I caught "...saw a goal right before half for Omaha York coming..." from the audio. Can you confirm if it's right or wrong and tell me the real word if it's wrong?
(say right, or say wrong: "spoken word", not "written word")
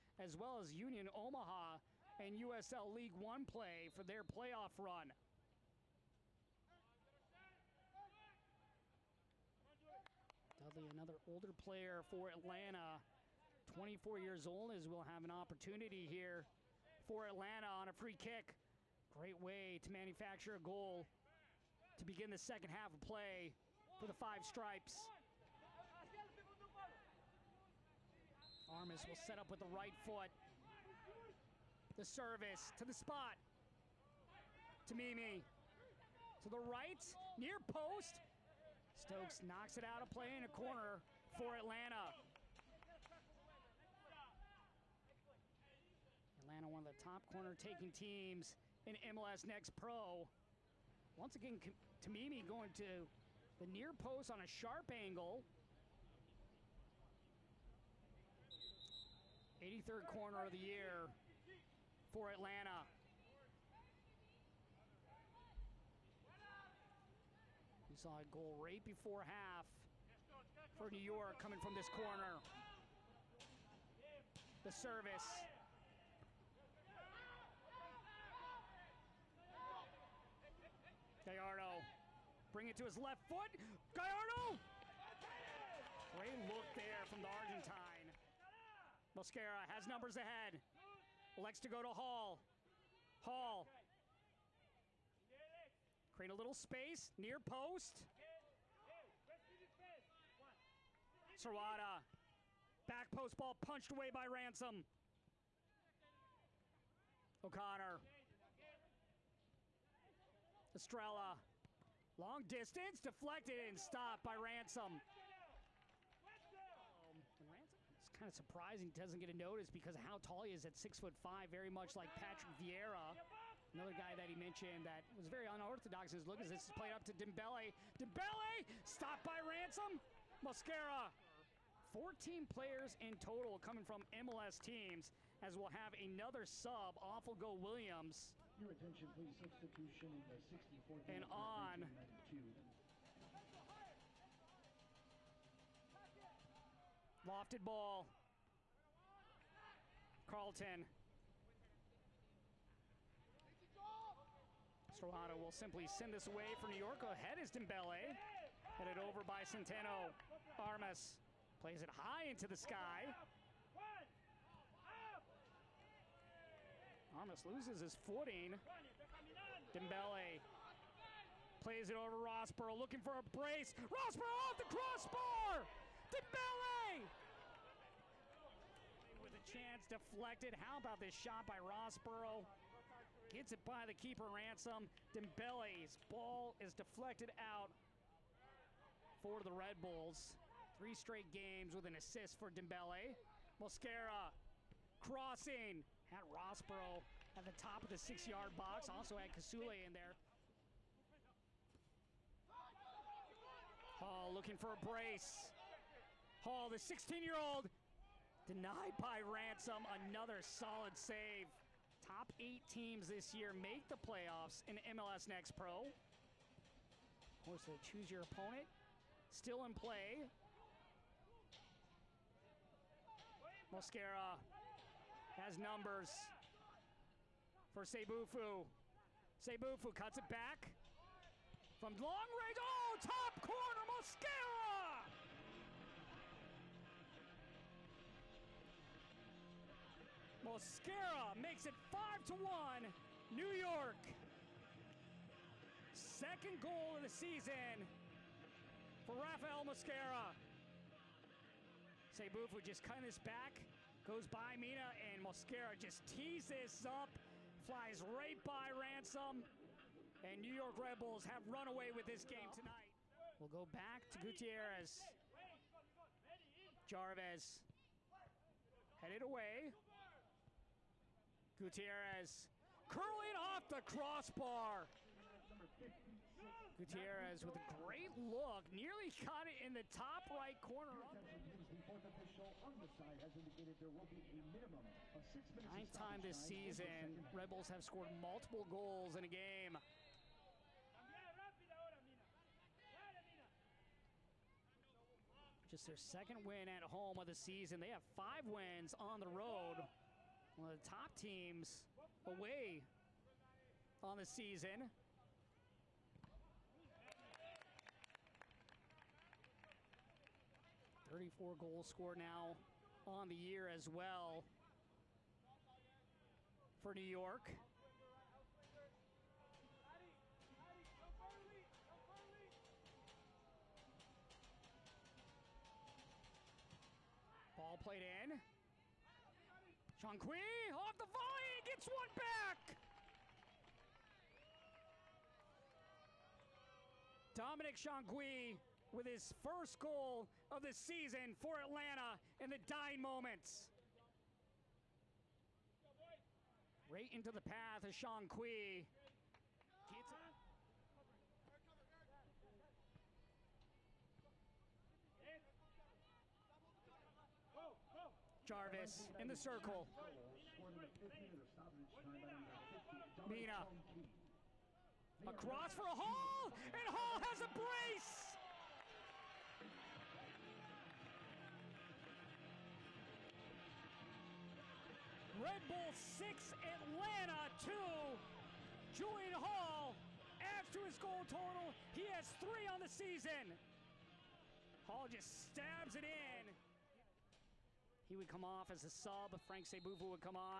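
wrong: "New", not "Omaha".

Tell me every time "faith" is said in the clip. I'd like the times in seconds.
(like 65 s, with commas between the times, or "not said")
not said.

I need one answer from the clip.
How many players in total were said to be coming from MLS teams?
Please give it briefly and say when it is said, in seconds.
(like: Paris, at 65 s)
14, at 131 s.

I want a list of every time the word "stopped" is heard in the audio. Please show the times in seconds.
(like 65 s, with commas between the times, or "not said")
113 s, 128 s.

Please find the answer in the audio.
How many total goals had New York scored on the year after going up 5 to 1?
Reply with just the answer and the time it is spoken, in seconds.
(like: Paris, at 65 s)
34, at 311 s.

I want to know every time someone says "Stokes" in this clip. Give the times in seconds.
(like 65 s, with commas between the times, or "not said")
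38 s.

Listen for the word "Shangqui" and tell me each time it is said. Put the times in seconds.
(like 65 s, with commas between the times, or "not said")
329 s, 337 s, 347 s.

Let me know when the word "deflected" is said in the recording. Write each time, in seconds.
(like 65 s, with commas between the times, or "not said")
112 s, 179 s, 186 s.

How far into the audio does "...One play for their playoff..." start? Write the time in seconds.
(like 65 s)
3 s.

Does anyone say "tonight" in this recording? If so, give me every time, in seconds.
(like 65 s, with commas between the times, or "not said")
262 s.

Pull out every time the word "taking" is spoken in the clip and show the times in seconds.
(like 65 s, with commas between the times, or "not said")
47 s.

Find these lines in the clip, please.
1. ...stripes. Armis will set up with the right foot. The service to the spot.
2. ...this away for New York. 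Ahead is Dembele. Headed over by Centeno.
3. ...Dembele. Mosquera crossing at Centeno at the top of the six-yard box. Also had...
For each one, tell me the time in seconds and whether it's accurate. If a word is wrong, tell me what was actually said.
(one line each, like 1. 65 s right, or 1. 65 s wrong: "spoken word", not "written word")
1. 24 s right
2. 156 s right
3. 192 s wrong: "Rosborough", not "Centeno".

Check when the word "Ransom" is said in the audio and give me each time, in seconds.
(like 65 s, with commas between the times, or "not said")
104 s, 114 s, 129 s, 184 s, 209 s, 258 s.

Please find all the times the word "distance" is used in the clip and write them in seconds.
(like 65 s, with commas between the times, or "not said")
112 s.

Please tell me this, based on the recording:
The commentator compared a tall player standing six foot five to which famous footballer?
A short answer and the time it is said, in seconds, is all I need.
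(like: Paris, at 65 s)
Patrick Vieira, at 122 s.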